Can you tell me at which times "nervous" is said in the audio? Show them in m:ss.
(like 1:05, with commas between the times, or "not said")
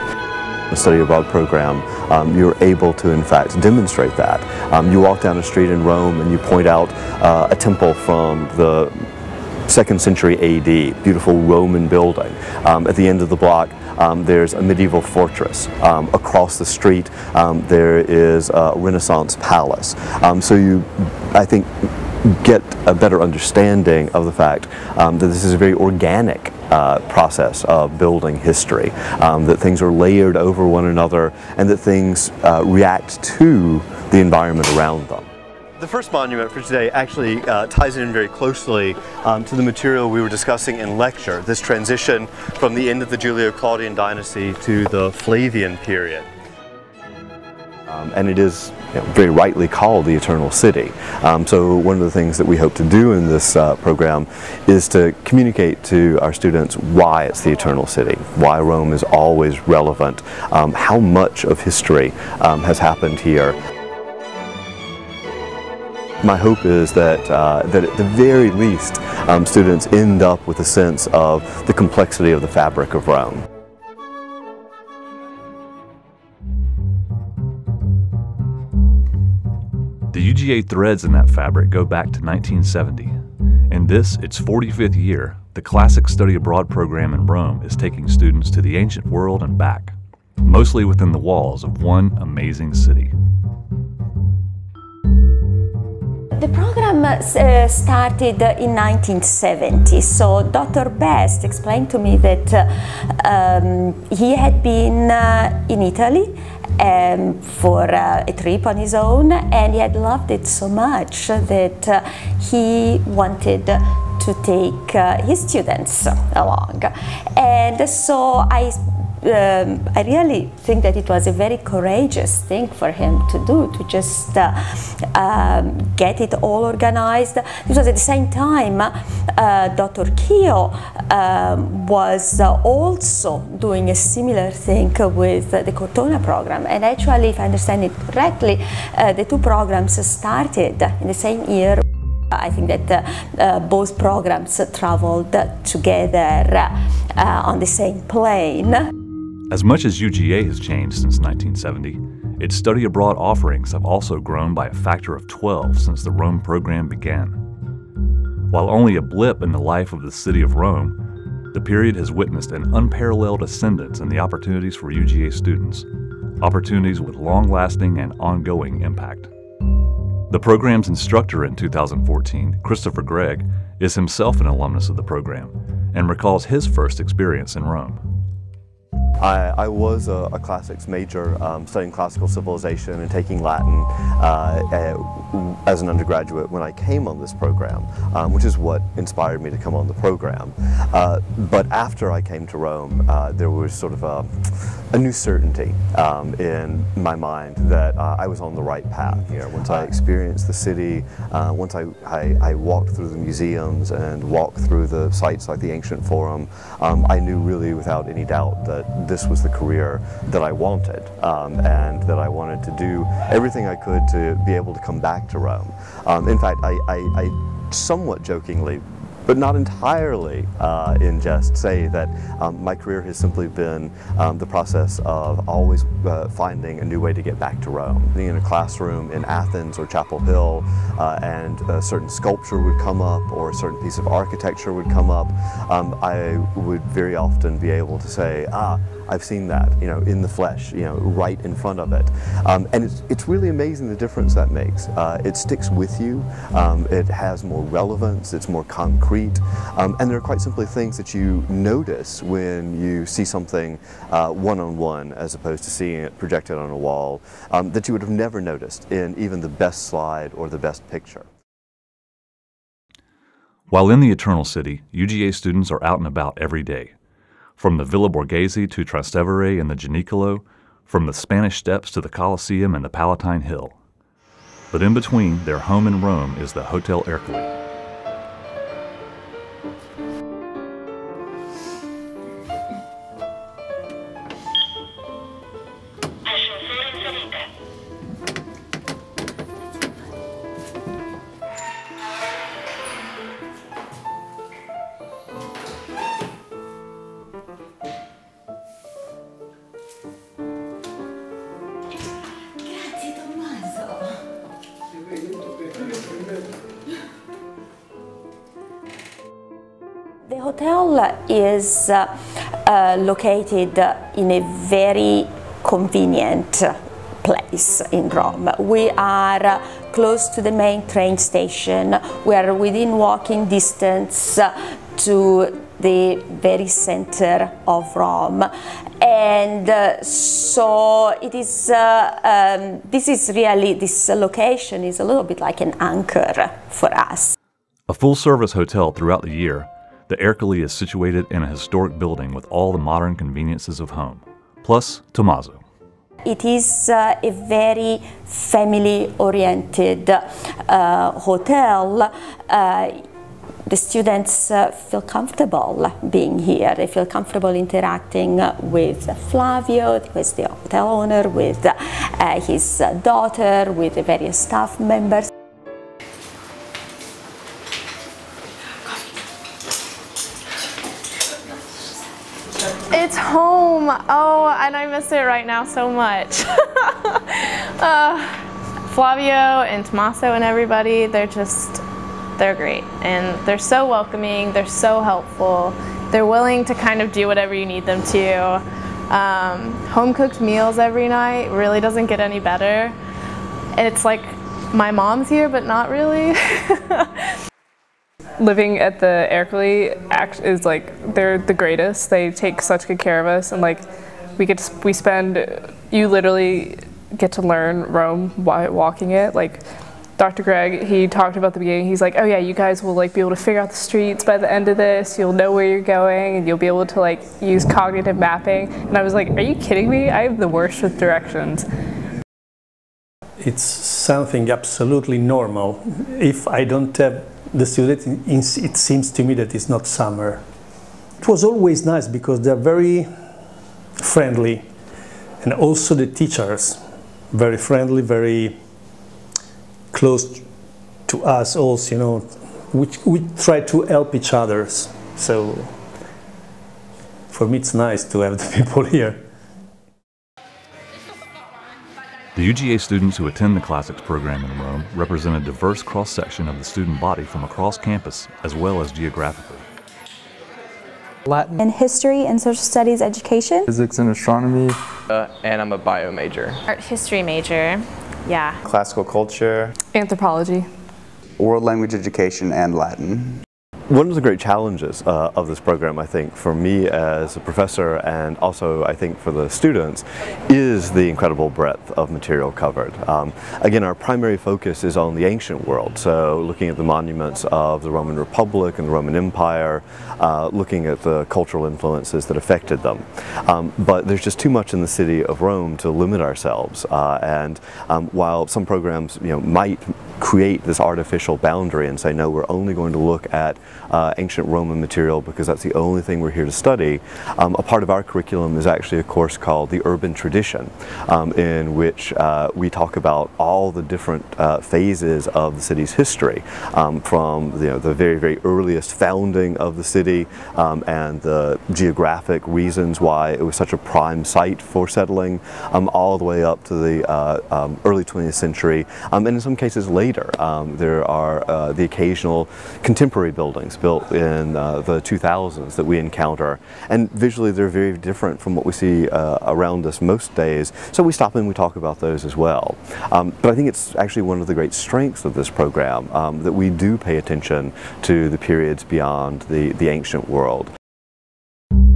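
not said.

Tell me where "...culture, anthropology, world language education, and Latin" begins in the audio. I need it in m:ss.
7:49.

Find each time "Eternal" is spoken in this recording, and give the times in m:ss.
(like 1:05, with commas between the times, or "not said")
0:50, 0:57, 4:24.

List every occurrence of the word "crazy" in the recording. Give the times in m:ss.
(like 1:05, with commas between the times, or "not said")
not said.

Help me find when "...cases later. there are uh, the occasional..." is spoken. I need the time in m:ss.
8:49.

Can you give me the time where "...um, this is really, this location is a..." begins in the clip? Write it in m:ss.
5:32.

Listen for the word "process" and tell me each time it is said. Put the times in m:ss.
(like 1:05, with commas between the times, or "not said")
0:27, 3:44.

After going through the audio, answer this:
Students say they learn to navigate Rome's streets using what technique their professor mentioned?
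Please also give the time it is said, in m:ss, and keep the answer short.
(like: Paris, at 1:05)
Cognitive mapping, at 6:57.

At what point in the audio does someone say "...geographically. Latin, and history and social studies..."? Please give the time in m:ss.
7:38.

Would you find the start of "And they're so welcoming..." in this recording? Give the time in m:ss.
6:22.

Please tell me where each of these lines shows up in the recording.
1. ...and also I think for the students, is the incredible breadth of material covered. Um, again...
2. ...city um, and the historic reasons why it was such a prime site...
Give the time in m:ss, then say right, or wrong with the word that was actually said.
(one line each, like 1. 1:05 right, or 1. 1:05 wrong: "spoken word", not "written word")
1. 7:57 right
2. 8:39 wrong: "geographic", not "historic".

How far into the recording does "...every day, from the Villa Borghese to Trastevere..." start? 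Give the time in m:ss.
4:26.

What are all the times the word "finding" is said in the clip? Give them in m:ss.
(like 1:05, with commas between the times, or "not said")
3:46.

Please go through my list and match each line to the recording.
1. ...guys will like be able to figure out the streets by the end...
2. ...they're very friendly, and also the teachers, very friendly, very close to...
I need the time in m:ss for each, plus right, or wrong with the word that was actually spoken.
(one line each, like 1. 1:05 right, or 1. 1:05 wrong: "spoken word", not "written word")
1. 6:52 right
2. 7:12 right.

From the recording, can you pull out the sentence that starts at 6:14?
and I miss it right now so much.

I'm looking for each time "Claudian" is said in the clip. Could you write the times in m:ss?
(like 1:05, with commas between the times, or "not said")
0:43.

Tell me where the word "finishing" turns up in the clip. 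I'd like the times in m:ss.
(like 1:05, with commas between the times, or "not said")
not said.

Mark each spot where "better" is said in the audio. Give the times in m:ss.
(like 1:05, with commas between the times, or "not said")
0:22, 6:32.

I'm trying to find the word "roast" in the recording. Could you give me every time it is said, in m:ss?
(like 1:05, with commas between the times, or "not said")
not said.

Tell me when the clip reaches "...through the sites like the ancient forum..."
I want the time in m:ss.
3:24.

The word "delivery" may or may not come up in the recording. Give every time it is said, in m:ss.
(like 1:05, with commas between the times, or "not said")
not said.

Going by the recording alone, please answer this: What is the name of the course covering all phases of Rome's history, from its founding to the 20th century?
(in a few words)
The Urban Tradition.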